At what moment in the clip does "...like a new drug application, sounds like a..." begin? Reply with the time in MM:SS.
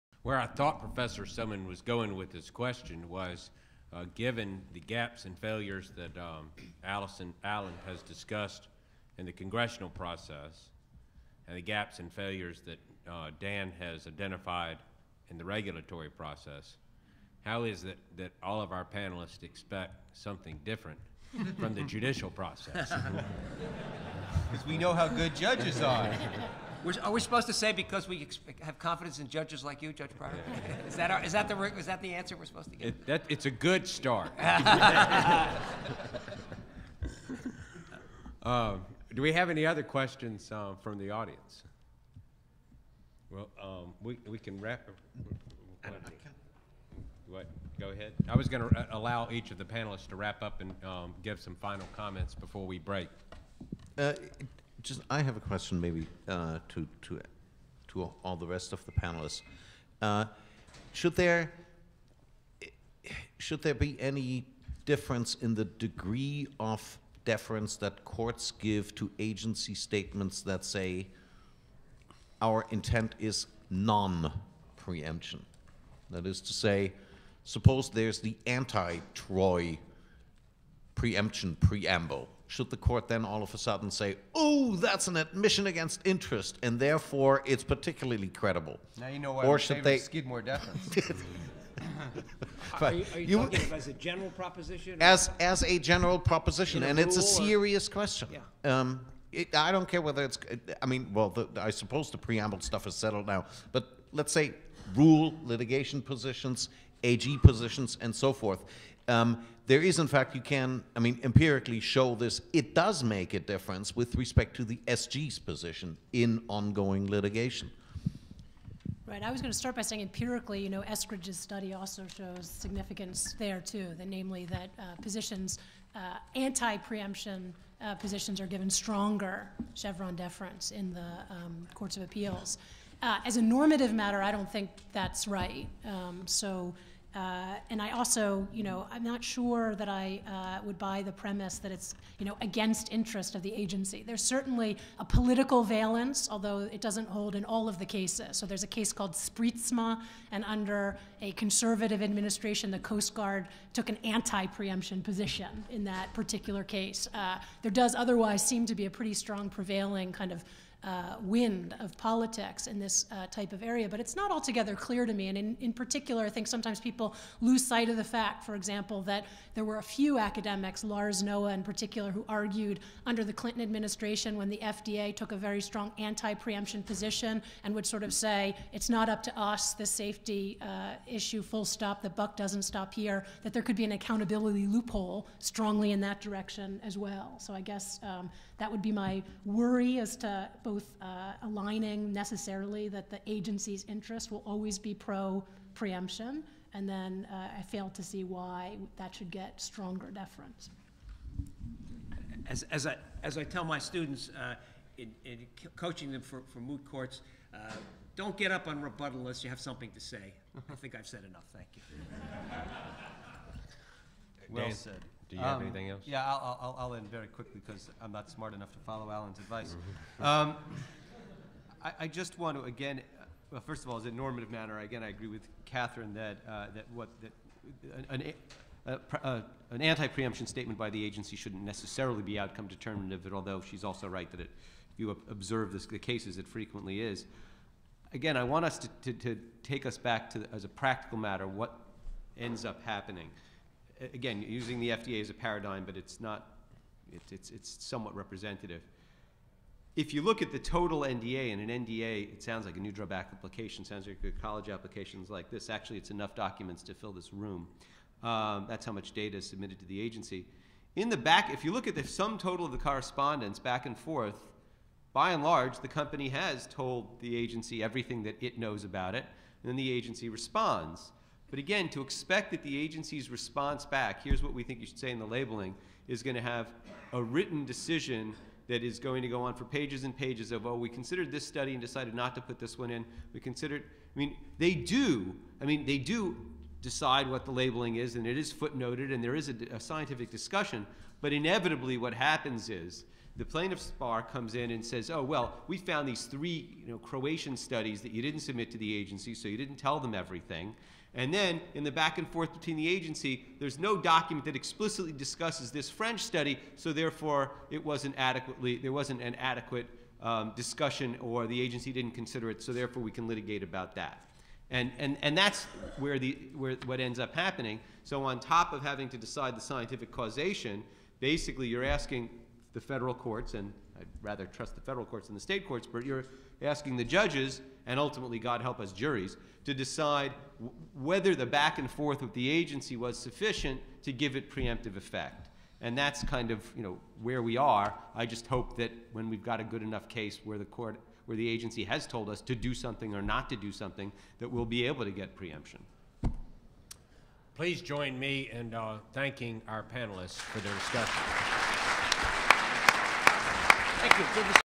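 04:12.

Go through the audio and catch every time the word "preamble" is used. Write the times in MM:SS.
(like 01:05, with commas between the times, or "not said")
01:21, 01:42.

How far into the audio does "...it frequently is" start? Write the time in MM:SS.
03:56.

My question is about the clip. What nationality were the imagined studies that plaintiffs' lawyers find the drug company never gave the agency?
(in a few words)
Croatian.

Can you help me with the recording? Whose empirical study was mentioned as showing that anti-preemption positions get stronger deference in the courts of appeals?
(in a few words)
Eskridge.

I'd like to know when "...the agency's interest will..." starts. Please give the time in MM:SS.
03:13.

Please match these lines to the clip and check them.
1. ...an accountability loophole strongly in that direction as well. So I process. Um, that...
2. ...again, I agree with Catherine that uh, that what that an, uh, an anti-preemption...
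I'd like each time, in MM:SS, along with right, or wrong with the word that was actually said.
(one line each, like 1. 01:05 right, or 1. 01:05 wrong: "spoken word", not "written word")
1. 03:03 wrong: "guess", not "process"
2. 03:44 right.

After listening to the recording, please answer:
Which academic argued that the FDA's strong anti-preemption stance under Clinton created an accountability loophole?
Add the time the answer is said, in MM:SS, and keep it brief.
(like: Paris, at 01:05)
Lars Noah, at 02:50.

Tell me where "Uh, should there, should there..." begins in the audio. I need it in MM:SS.
01:00.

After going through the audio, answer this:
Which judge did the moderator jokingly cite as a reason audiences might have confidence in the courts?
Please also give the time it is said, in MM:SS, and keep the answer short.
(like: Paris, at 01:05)
Judge Pryor, at 00:29.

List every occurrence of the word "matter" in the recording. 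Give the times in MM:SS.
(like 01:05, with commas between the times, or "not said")
02:13, 03:44, 04:01.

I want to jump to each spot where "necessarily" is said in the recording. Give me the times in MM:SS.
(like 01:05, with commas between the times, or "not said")
03:12, 03:51.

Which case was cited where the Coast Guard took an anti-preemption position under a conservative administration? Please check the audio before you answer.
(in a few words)
Sprietsma.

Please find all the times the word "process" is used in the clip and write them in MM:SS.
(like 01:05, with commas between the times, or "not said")
00:09, 00:16, 00:22.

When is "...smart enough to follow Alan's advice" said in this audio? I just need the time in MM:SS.
03:38.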